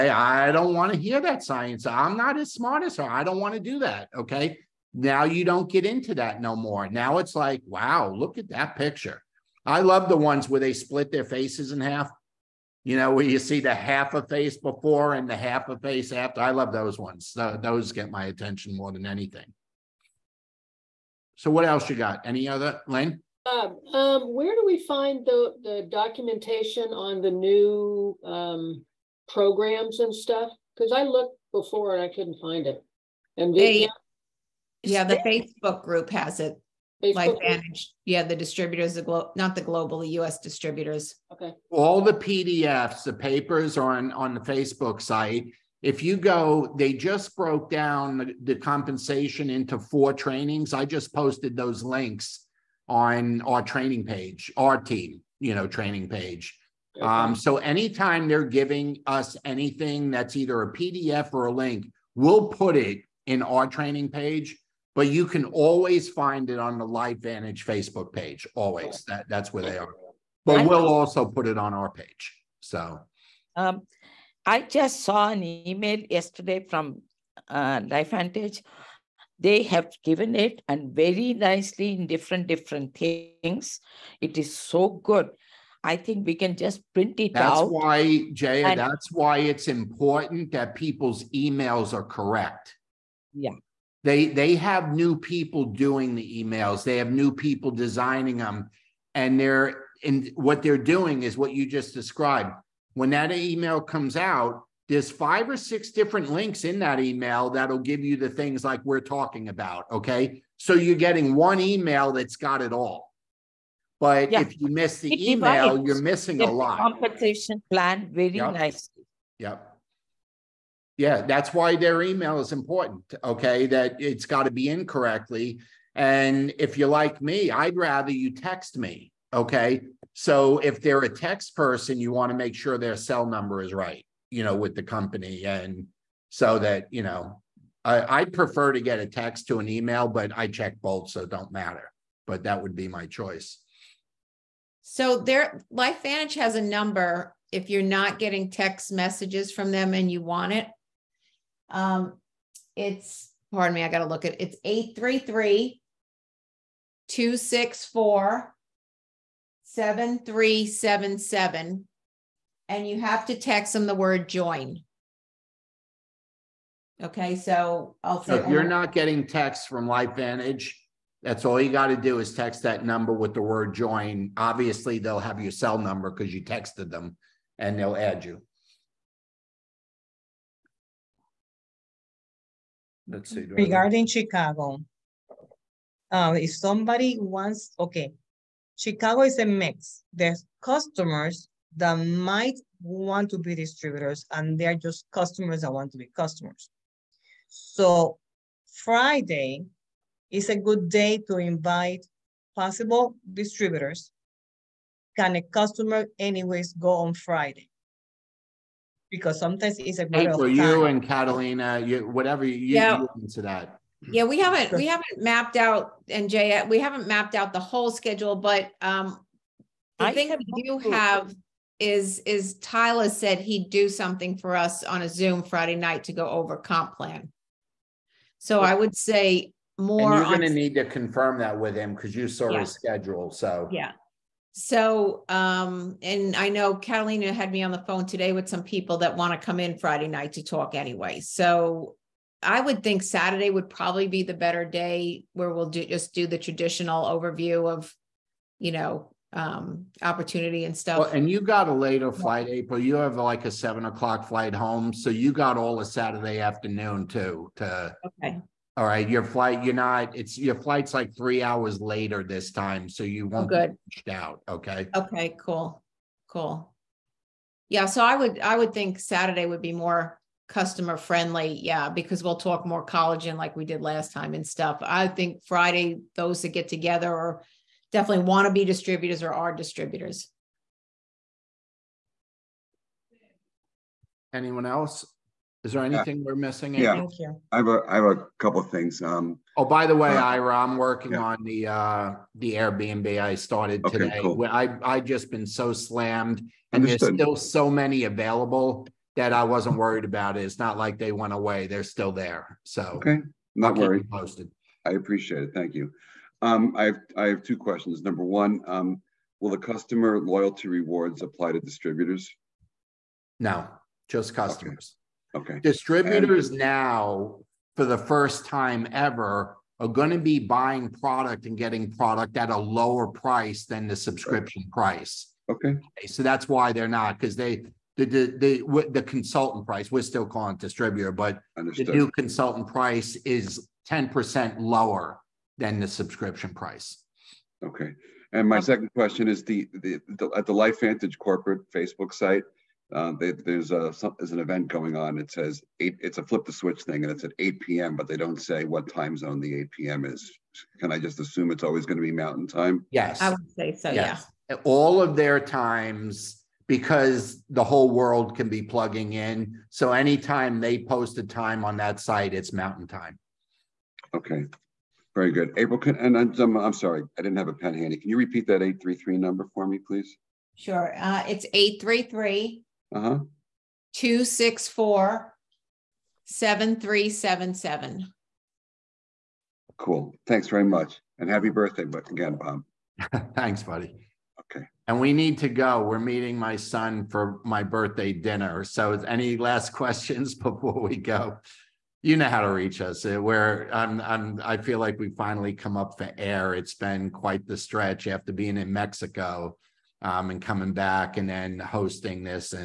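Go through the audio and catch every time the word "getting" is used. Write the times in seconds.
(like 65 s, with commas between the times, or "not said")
110 s, 148 s, 168 s, 321 s.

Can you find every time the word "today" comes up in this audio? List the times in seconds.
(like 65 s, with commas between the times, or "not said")
238 s, 293 s.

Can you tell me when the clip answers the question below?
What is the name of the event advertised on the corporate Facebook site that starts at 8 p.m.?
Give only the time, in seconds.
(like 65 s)
346 s.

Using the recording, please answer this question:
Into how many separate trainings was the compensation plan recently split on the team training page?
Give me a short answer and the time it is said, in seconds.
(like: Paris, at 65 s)
4, at 49 s.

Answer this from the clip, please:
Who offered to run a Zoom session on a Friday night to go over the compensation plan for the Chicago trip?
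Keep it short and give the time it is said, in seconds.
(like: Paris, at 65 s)
Tyler, at 222 s.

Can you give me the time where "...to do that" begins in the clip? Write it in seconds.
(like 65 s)
3 s.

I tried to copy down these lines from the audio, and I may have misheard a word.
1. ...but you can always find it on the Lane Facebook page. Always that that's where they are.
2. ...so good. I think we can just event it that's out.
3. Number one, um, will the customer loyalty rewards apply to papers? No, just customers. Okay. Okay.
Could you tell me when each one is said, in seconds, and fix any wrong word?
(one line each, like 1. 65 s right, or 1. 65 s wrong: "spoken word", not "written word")
1. 64 s wrong: "LifeVantage", not "Lane"
2. 84 s wrong: "print", not "event"
3. 308 s wrong: "distributors", not "papers".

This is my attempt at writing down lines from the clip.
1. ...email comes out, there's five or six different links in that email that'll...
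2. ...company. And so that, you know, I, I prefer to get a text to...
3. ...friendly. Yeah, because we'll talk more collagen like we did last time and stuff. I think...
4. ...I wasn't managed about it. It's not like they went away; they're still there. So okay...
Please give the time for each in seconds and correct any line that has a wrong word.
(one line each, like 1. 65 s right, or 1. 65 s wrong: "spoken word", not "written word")
1. 103 s right
2. 134 s right
3. 270 s right
4. 299 s wrong: "worried", not "managed".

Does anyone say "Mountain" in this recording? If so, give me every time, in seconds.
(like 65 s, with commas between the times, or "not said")
352 s, 362 s.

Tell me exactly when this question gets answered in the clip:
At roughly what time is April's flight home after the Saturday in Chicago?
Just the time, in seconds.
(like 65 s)
253 s.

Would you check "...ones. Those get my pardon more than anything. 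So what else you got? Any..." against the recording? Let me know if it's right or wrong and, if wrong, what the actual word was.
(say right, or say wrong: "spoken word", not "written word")
wrong: "attention", not "pardon".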